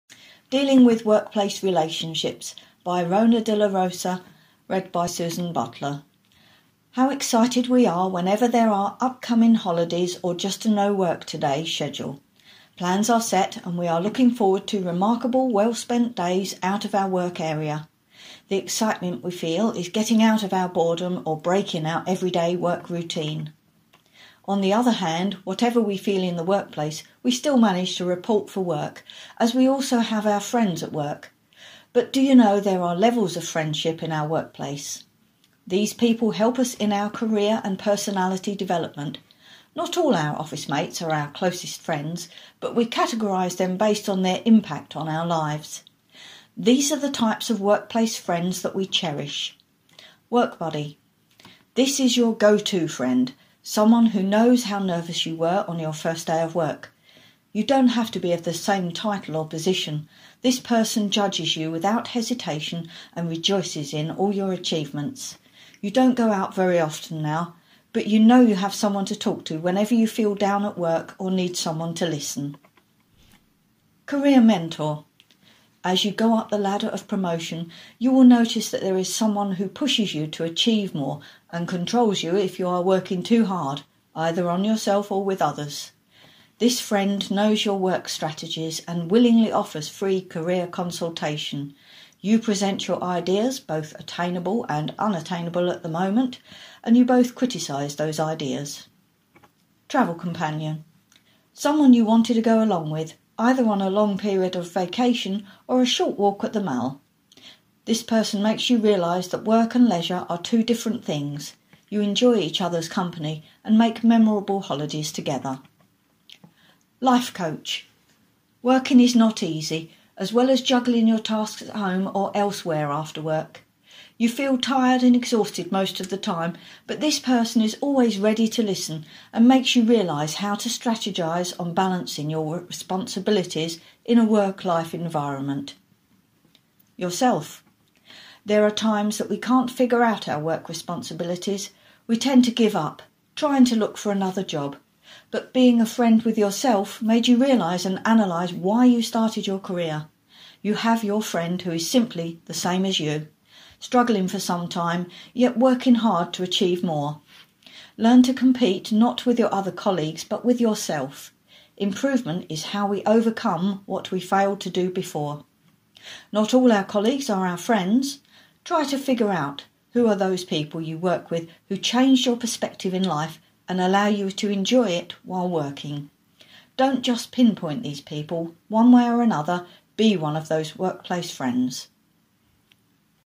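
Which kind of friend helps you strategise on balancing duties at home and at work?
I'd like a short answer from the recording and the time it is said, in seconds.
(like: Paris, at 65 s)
Life coach, at 116 s.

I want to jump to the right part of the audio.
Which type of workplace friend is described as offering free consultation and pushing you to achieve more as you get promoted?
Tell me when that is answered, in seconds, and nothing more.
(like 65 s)
74 s.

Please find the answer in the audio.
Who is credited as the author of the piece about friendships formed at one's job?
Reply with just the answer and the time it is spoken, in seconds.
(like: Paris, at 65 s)
Rona dela Rosa, at 3 s.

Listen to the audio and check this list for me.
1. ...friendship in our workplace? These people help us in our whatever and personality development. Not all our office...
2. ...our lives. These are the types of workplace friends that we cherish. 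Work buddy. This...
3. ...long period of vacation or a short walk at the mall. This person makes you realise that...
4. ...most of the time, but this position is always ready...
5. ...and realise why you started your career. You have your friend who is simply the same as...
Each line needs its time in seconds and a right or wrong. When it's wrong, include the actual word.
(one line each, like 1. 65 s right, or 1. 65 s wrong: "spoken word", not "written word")
1. 33 s wrong: "career", not "whatever"
2. 45 s right
3. 103 s right
4. 125 s wrong: "person", not "position"
5. 147 s wrong: "analyse", not "realise".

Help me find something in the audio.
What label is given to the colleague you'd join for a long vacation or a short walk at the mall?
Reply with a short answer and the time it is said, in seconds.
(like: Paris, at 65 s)
Travel companion, at 99 s.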